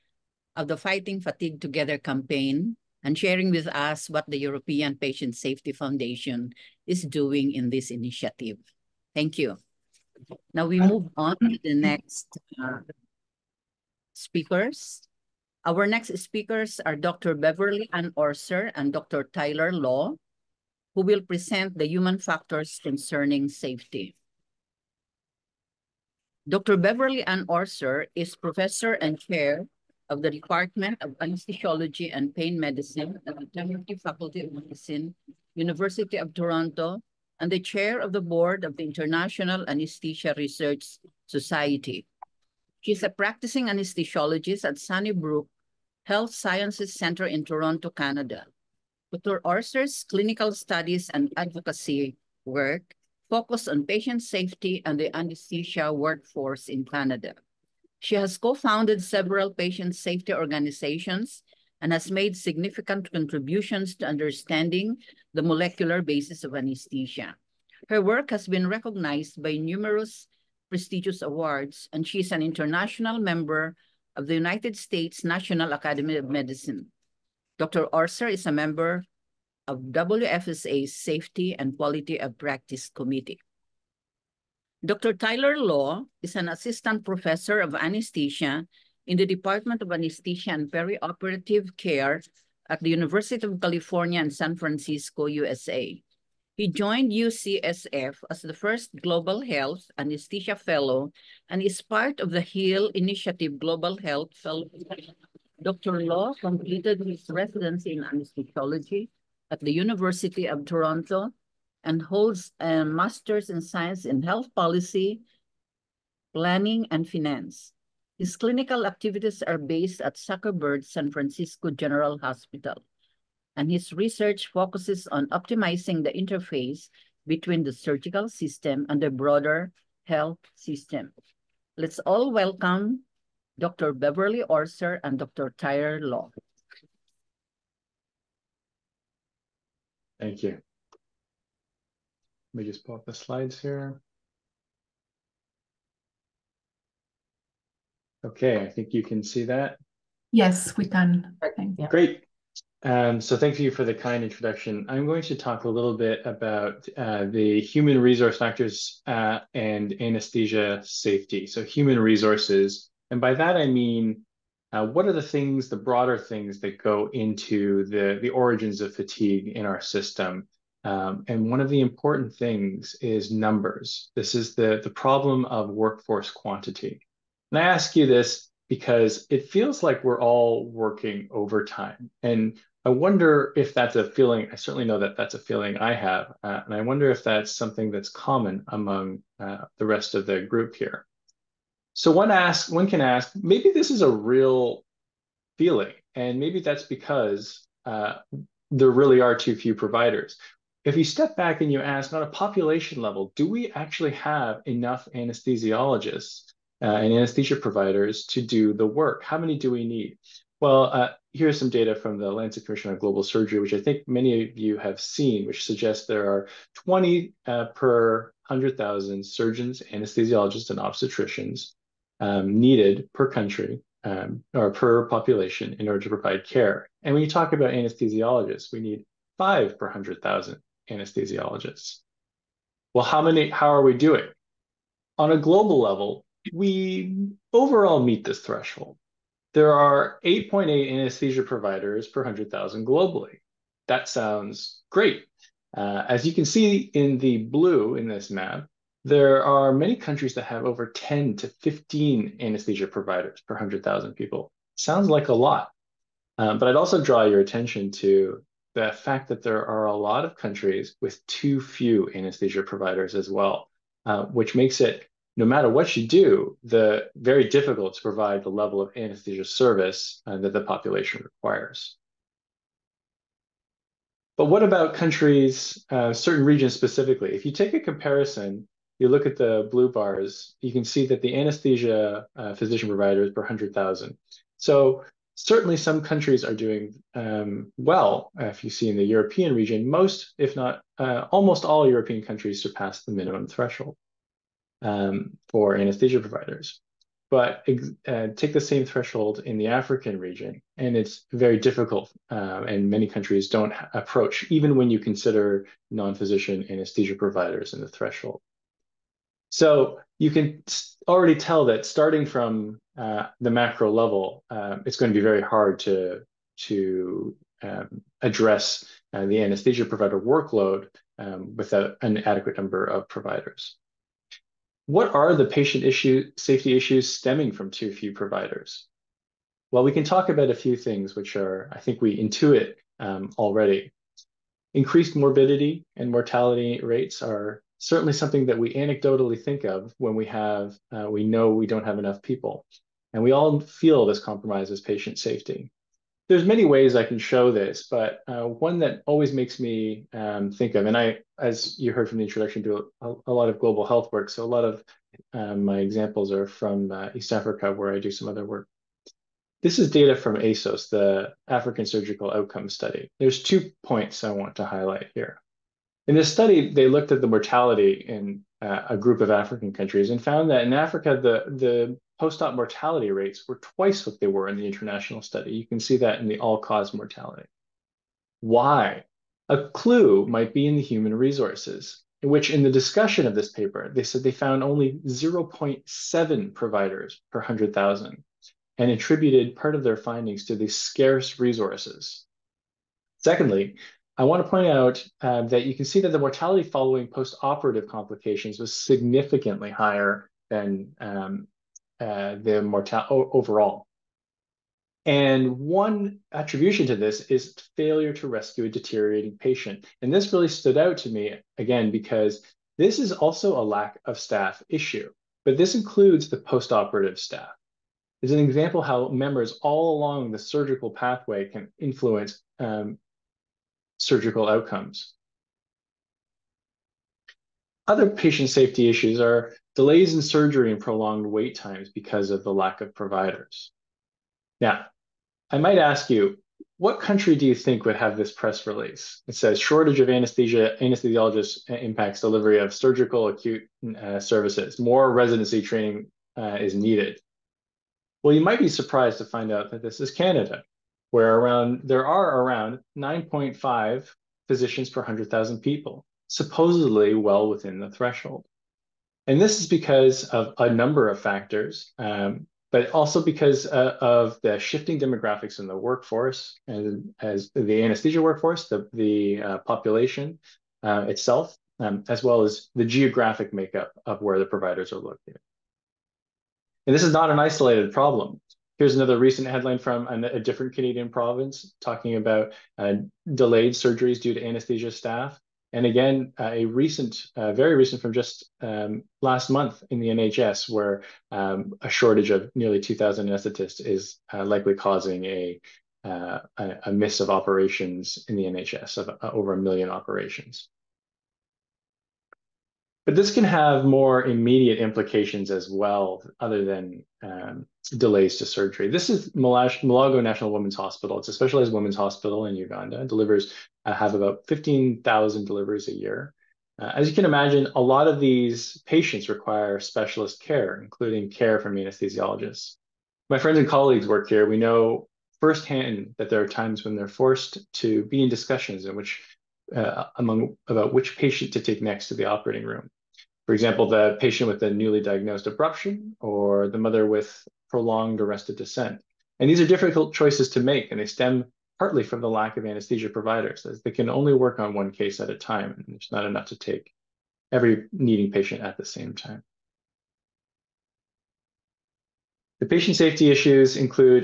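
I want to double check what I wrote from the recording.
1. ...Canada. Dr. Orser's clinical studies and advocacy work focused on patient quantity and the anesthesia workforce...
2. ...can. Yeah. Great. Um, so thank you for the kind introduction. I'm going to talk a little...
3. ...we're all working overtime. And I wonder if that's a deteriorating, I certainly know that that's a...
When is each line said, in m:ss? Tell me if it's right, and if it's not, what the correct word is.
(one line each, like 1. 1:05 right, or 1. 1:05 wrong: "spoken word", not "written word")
1. 0:47 wrong: "safety", not "quantity"
2. 2:30 right
3. 3:00 wrong: "feeling", not "deteriorating".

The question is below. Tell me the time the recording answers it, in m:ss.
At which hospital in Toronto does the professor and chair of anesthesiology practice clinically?
0:44.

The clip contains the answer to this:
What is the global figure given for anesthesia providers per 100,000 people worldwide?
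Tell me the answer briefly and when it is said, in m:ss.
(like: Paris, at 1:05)
8.8, at 4:00.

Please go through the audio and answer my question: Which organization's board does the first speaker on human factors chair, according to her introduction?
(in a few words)
International Anesthesia Research Society.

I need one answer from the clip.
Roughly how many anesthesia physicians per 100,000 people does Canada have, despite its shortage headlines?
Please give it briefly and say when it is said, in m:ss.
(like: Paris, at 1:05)
9.5, at 7:32.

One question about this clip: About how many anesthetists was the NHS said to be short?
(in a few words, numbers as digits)
2,000.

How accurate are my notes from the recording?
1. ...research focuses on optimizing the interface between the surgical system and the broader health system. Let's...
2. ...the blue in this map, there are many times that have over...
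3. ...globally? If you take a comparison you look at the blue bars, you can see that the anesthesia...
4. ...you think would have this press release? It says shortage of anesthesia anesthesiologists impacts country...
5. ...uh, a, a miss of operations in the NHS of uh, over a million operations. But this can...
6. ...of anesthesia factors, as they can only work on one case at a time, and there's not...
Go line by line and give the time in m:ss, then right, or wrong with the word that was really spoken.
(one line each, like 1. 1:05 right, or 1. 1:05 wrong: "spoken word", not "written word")
1. 2:03 right
2. 4:07 wrong: "countries", not "times"
3. 4:36 wrong: "specifically", not "globally"
4. 7:17 wrong: "delivery", not "country"
5. 8:16 right
6. 9:02 wrong: "providers", not "factors".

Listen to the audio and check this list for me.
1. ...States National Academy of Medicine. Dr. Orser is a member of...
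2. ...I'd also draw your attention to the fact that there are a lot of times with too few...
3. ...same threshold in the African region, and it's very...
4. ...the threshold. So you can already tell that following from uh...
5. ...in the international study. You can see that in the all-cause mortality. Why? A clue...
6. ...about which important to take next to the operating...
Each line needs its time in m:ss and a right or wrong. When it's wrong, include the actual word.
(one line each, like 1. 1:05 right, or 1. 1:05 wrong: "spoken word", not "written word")
1. 1:14 right
2. 4:16 wrong: "countries", not "times"
3. 4:58 right
4. 5:07 wrong: "starting", not "following"
5. 6:14 right
6. 8:50 wrong: "patient", not "important".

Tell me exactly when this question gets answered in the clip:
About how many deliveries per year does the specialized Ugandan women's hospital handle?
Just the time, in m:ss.
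8:34.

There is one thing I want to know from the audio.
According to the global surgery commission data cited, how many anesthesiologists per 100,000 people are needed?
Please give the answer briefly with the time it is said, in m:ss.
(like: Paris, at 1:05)
5, at 3:49.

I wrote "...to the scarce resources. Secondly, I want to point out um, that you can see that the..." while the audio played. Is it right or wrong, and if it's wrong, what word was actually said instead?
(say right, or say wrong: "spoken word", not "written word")
right.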